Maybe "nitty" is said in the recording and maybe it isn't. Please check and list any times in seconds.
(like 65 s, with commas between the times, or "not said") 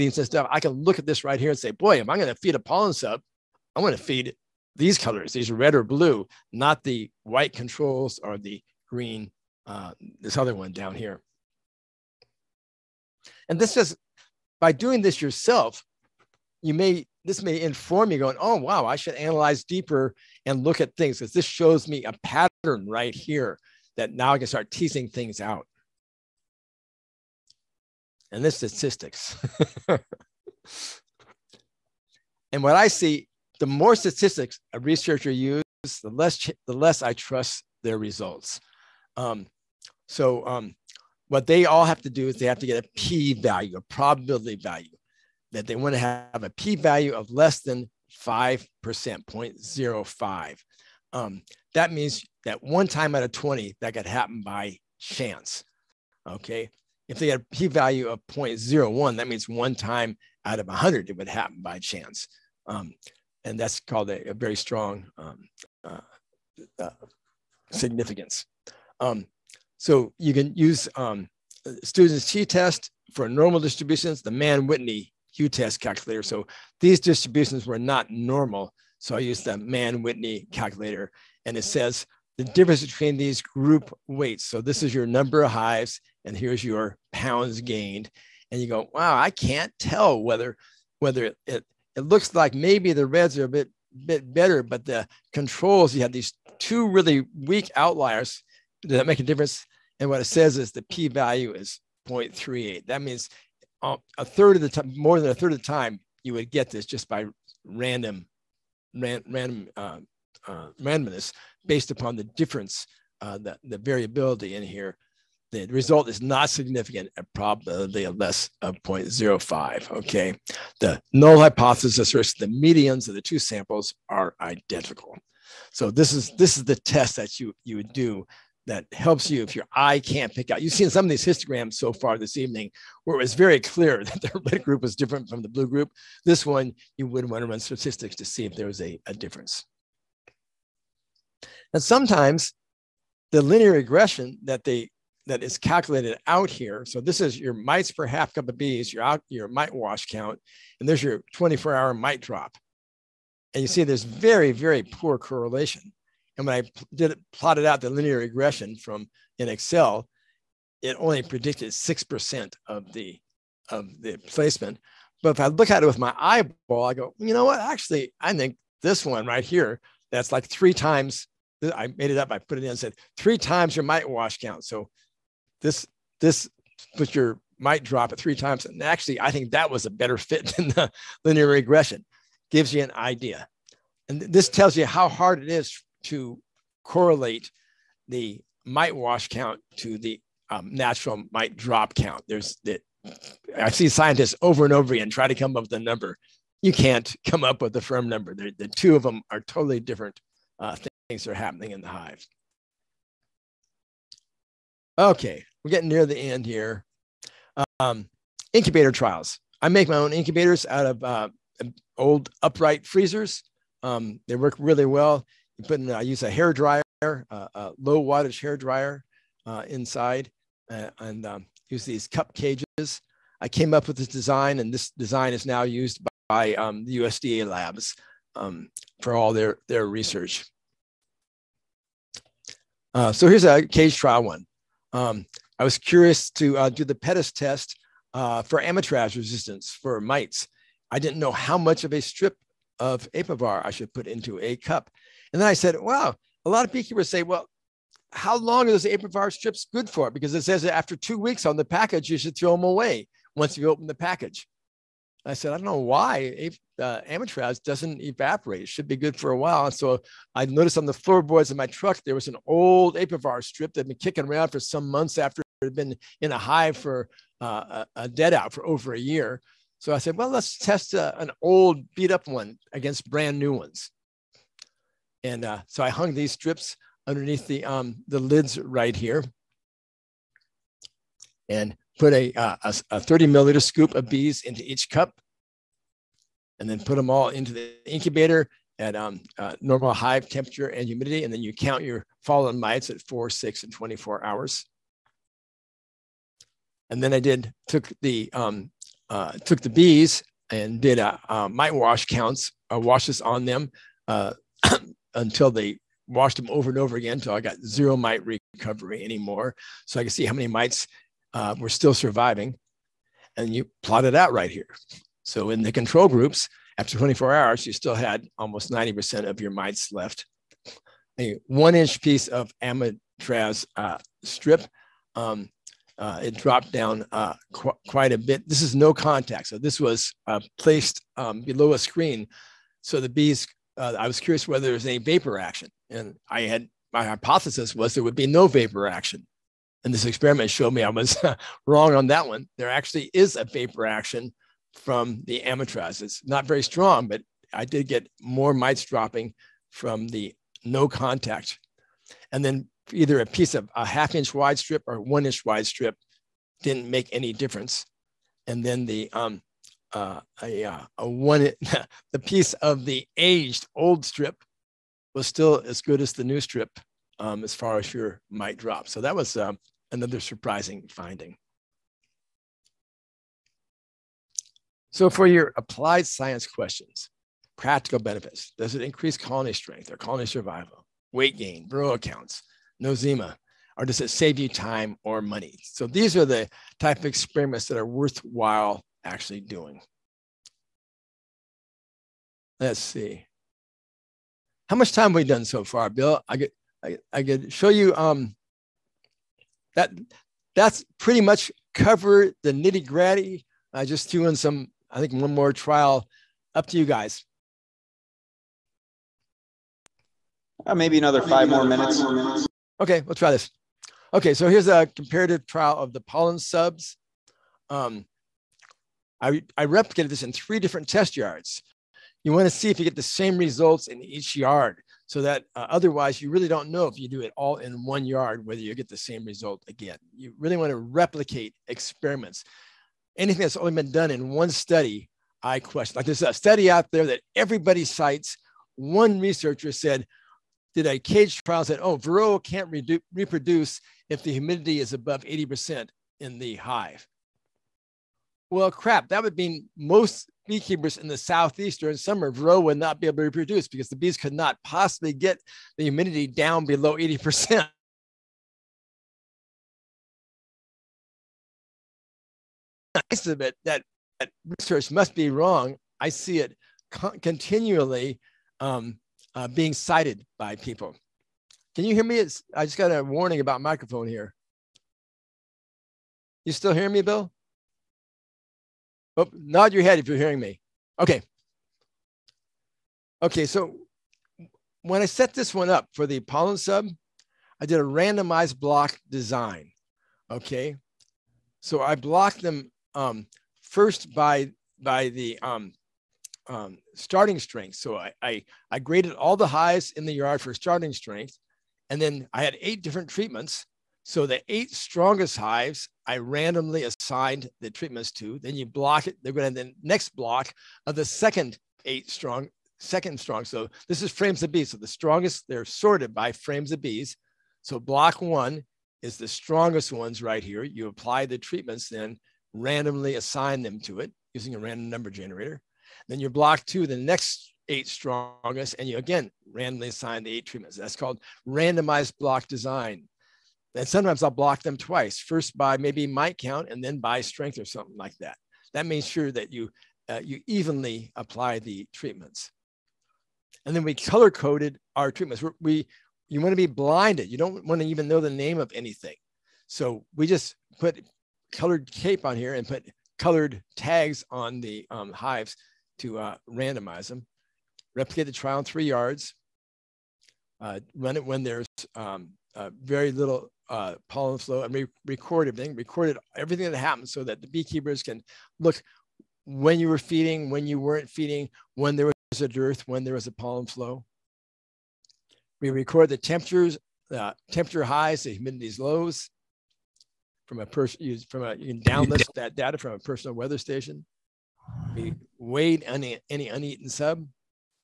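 402 s.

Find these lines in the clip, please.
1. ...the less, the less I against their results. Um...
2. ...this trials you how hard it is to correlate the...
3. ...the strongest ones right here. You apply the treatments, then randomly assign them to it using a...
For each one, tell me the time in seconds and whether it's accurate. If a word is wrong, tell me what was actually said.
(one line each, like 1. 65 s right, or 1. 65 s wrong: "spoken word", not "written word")
1. 36 s wrong: "trust", not "against"
2. 184 s wrong: "tells", not "trials"
3. 519 s right.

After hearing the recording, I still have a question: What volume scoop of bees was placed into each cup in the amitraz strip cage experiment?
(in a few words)
30 milliliters.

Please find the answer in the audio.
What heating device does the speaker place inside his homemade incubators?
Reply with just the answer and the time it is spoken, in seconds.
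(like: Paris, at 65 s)
Low wattage hair dryer, at 217 s.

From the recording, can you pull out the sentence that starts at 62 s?
Um, and that's called a, a very strong um, uh, uh, significance.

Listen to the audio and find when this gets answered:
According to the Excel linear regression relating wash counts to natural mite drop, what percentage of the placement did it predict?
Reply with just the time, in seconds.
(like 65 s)
161 s.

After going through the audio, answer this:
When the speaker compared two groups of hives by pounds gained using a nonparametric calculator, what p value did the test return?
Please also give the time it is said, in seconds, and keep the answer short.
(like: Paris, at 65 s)
0.38, at 102 s.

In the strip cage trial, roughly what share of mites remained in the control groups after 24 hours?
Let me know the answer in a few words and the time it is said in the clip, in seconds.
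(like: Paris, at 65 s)
Almost 90%, at 318 s.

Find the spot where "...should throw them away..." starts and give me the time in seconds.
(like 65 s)
252 s.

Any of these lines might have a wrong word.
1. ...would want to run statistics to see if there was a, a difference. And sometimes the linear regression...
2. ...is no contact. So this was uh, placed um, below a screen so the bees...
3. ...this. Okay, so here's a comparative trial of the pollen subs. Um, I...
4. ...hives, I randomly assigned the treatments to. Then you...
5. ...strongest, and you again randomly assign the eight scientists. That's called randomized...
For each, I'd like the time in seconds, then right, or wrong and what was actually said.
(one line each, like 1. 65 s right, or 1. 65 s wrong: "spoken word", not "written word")
1. 137 s right
2. 328 s right
3. 413 s right
4. 505 s right
5. 527 s wrong: "treatments", not "scientists".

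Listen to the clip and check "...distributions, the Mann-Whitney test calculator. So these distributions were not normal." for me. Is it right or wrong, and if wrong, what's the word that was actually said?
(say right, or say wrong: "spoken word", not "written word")
right.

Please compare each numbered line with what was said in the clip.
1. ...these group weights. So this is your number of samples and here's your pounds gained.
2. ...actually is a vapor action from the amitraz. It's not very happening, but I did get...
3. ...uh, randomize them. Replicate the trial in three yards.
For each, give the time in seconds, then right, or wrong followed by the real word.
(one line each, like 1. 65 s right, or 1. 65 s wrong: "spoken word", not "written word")
1. 83 s wrong: "hives", not "samples"
2. 342 s wrong: "strong", not "happening"
3. 556 s right.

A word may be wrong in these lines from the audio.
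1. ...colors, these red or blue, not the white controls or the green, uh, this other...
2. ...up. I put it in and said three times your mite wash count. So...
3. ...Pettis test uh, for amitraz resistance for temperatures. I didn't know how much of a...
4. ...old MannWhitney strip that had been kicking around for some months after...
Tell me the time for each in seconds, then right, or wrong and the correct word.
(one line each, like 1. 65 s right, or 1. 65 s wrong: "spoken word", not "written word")
1. 4 s right
2. 172 s right
3. 236 s wrong: "mites", not "temperatures"
4. 262 s wrong: "Apivar", not "MannWhitney".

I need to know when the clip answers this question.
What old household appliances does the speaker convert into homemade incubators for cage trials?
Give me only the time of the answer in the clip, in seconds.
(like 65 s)
211 s.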